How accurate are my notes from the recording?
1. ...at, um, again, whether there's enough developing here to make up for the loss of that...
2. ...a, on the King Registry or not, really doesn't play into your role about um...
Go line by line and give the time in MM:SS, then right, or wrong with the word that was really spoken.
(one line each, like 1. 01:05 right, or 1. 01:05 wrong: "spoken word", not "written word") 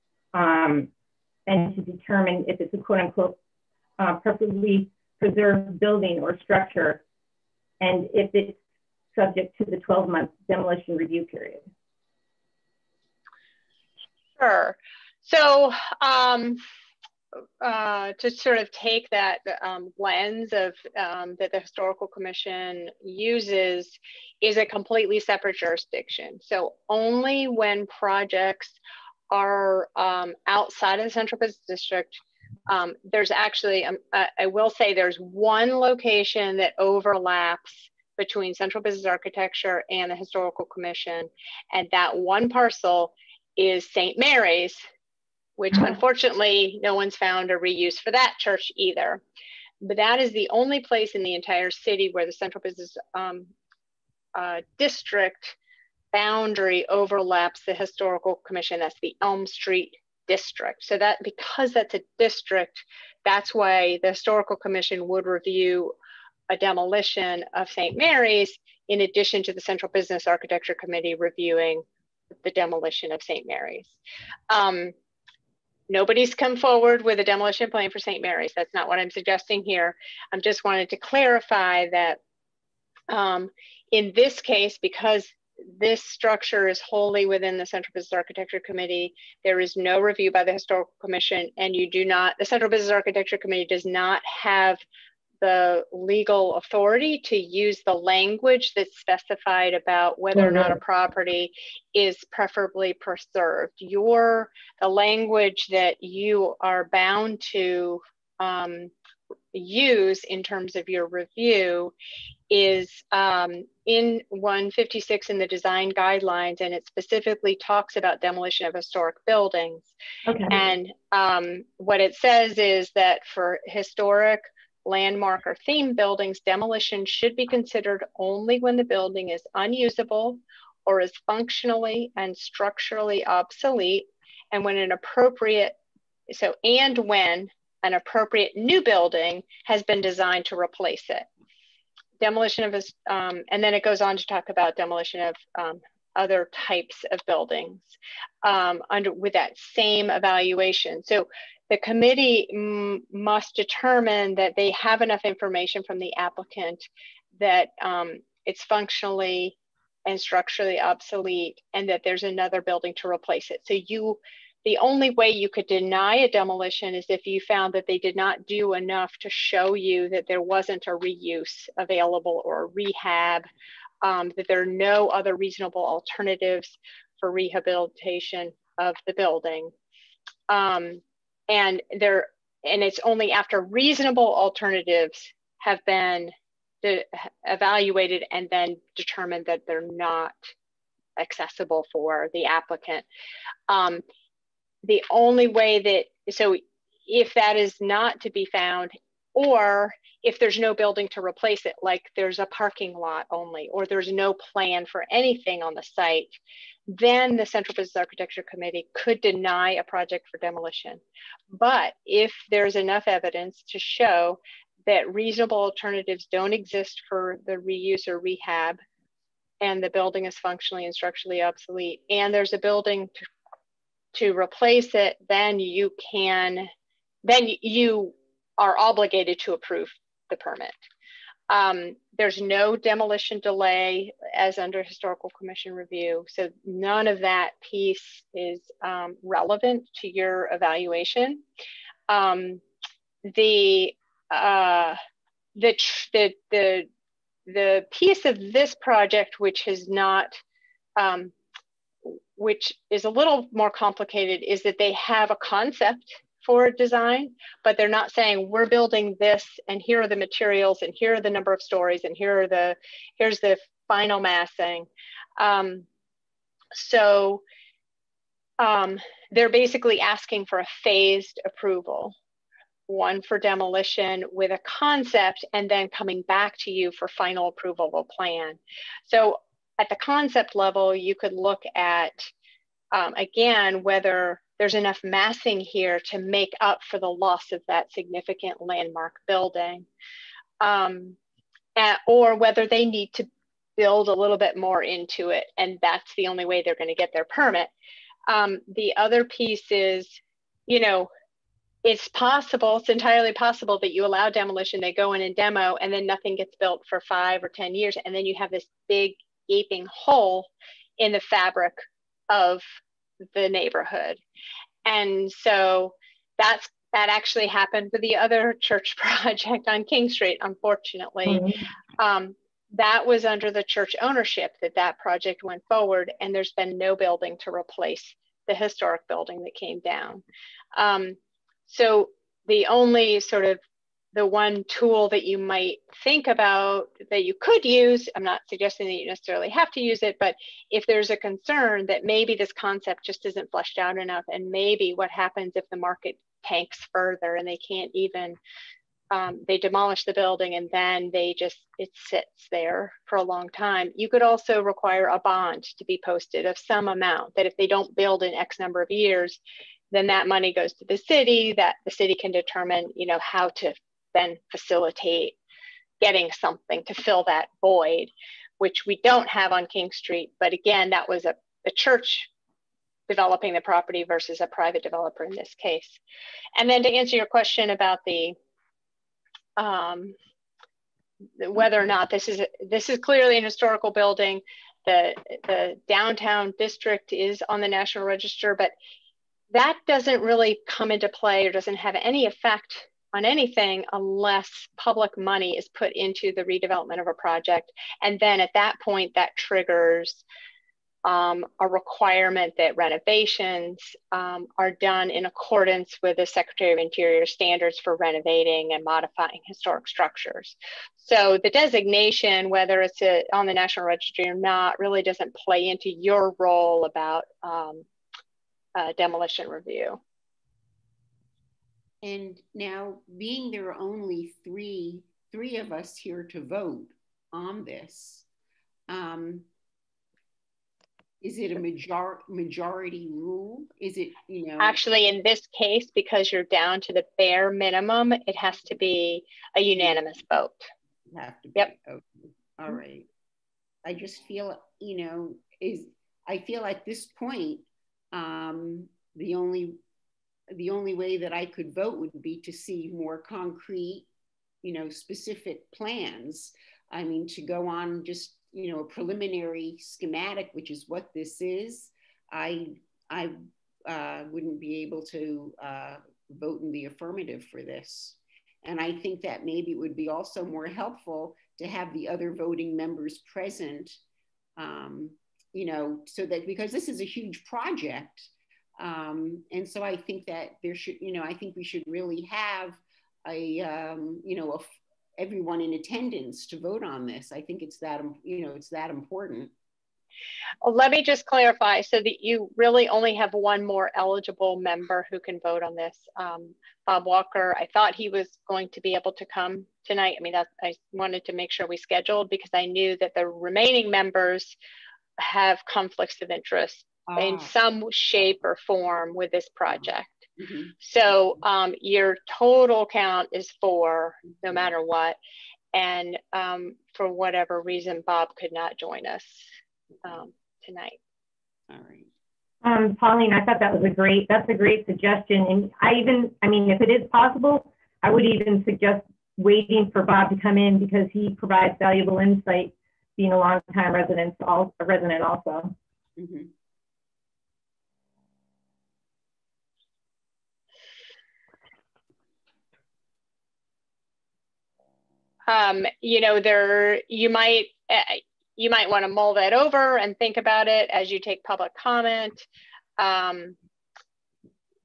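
1. 04:41 wrong: "massing", not "developing"
2. 06:53 wrong: "National", not "King".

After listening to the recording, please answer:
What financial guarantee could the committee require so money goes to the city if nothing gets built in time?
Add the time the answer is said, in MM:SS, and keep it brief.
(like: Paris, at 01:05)
a bond, at 05:55.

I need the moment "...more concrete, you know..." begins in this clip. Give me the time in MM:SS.
07:32.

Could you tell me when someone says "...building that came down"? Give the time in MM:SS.
05:29.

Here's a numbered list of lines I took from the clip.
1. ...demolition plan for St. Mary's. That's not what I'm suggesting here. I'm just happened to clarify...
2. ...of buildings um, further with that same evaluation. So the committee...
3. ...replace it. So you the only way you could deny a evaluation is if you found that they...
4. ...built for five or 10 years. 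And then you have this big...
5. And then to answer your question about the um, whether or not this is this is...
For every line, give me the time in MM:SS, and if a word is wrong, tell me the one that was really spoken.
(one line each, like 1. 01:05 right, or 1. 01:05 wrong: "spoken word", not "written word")
1. 01:17 wrong: "wanted", not "happened"
2. 02:27 wrong: "under", not "further"
3. 02:43 wrong: "demolition", not "evaluation"
4. 05:06 right
5. 06:16 right.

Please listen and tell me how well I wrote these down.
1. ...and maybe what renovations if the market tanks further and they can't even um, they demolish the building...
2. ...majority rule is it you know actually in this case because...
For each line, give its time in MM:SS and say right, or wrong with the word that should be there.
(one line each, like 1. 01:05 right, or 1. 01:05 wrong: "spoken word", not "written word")
1. 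05:44 wrong: "happens", not "renovations"
2. 07:12 right.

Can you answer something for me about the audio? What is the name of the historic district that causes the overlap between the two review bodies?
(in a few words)
Elm Street district.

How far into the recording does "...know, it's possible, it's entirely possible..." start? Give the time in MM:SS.
05:00.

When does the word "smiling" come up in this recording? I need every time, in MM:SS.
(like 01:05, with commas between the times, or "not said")
not said.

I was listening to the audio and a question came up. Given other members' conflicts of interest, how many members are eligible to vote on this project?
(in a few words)
4.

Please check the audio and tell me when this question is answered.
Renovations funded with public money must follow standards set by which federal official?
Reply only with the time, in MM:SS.
06:46.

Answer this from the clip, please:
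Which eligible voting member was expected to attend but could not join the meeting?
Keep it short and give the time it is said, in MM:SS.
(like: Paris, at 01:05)
Bob Walker, at 08:16.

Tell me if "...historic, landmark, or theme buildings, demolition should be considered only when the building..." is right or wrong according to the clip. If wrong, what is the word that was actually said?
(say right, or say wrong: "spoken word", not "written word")
right.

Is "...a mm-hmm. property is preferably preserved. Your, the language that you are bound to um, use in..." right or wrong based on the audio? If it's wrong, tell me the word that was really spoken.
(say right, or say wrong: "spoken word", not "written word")
right.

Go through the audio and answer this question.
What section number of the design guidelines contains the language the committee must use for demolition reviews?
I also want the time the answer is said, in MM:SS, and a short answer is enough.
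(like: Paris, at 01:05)
156, at 01:54.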